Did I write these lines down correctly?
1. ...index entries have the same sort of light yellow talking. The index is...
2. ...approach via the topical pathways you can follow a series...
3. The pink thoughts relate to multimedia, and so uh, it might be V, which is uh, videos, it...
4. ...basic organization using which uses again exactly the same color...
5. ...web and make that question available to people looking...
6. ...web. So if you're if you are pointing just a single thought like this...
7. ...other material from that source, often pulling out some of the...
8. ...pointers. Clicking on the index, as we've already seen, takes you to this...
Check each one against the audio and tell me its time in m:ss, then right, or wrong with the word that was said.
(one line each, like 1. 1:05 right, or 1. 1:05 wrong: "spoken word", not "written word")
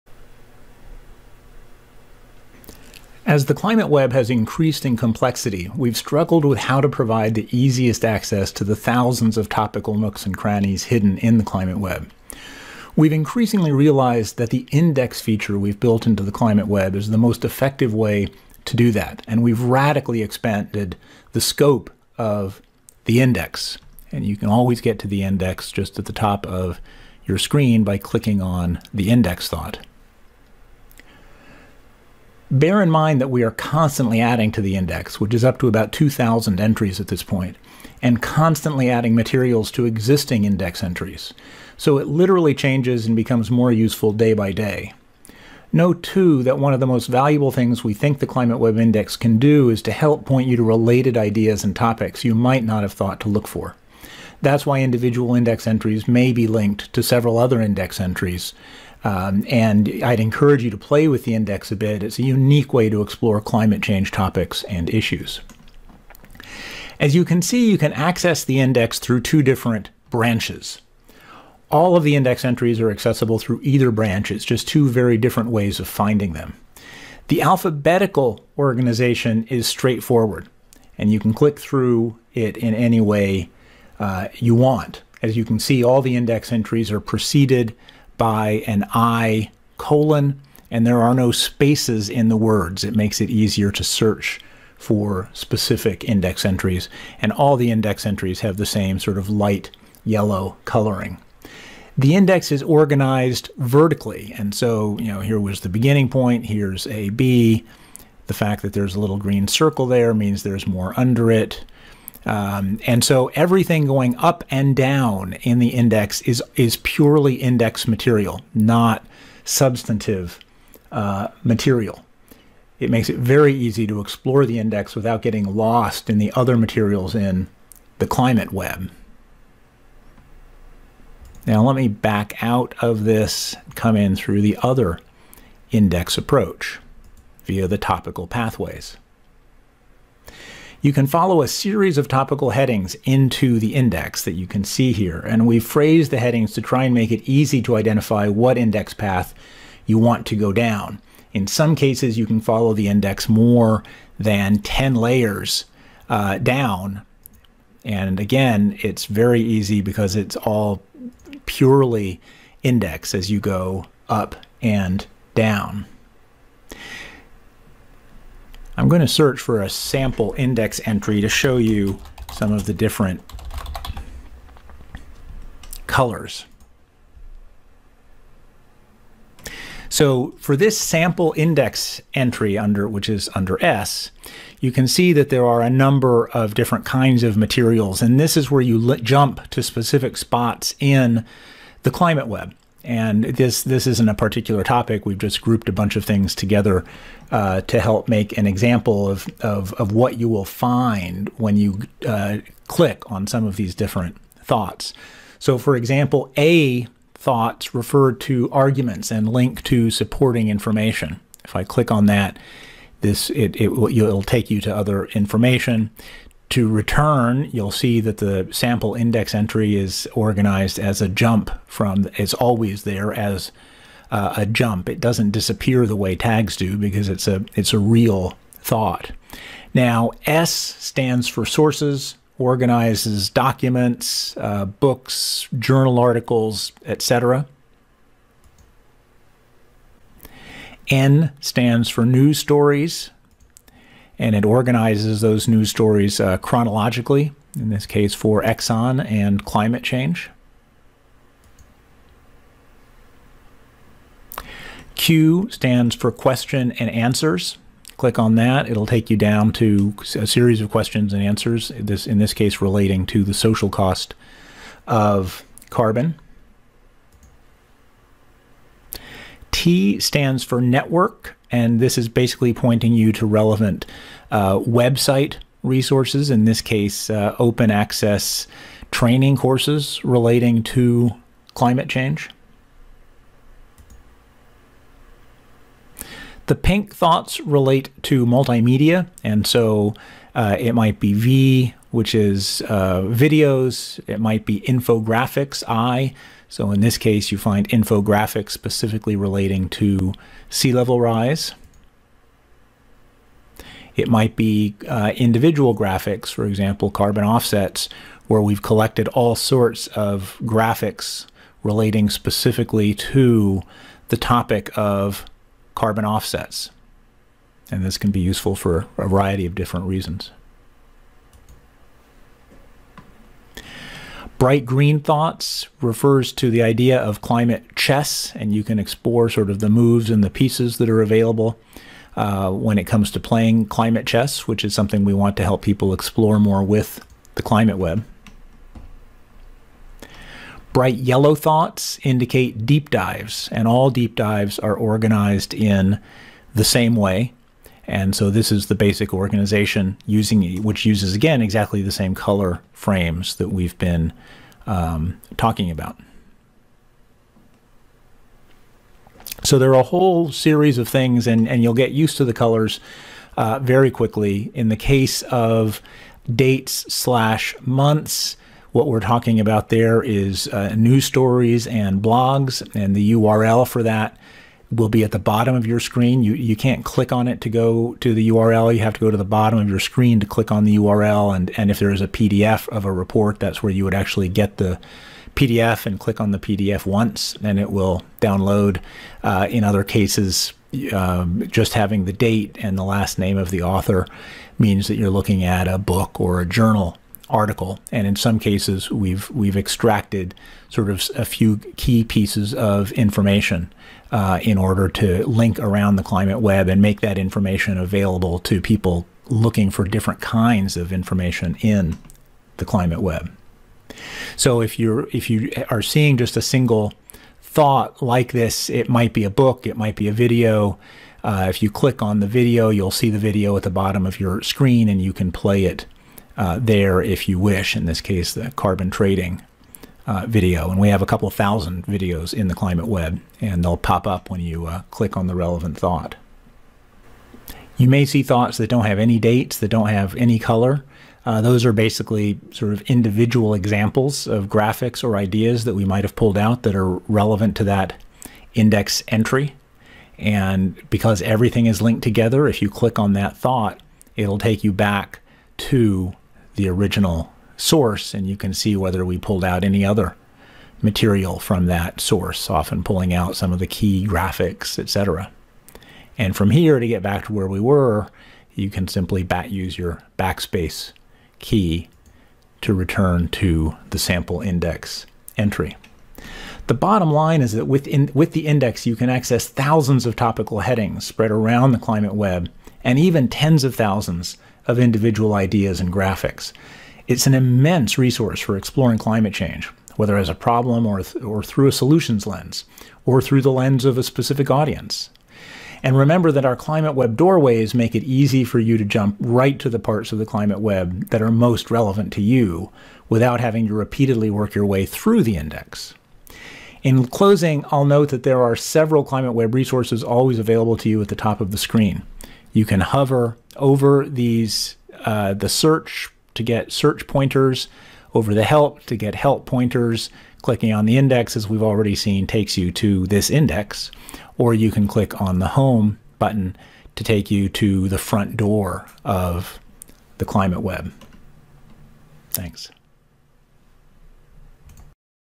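1. 1:37 wrong: "coloring", not "talking"
2. 2:16 right
3. 4:46 right
4. 5:48 right
5. 6:46 wrong: "information", not "question"
6. 6:52 wrong: "seeing", not "pointing"
7. 7:39 right
8. 8:39 right.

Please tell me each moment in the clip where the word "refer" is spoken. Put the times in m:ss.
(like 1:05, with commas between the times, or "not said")
3:27, 5:25.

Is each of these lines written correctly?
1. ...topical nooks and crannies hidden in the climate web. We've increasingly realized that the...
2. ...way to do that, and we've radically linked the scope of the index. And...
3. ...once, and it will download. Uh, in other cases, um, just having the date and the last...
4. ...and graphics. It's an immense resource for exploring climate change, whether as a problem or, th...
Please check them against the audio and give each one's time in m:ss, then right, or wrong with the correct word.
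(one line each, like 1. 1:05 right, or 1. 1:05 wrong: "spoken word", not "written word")
1. 0:09 right
2. 0:17 wrong: "expanded", not "linked"
3. 6:26 right
4. 8:05 right.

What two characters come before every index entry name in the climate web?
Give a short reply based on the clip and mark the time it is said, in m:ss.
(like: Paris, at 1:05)
I colon, at 1:28.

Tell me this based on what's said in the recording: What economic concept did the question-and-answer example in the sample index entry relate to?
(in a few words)
social cost of carbon.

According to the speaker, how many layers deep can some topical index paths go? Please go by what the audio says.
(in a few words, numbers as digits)
more than 10.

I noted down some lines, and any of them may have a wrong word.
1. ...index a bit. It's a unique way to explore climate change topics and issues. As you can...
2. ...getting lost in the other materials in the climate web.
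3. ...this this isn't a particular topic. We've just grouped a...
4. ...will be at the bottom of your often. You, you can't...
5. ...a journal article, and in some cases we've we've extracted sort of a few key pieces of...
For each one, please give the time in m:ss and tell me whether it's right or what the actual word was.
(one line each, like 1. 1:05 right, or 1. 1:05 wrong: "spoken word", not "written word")
1. 1:01 right
2. 2:05 right
3. 3:13 right
4. 6:14 wrong: "screen", not "often"
5. 6:36 right.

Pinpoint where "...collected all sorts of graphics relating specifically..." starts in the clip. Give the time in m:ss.
5:08.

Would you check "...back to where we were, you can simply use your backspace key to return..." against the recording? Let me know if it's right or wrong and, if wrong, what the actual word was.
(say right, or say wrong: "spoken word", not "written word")
right.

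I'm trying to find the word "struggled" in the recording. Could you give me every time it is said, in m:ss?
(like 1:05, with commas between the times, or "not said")
0:05.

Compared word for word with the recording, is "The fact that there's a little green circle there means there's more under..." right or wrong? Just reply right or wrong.
right.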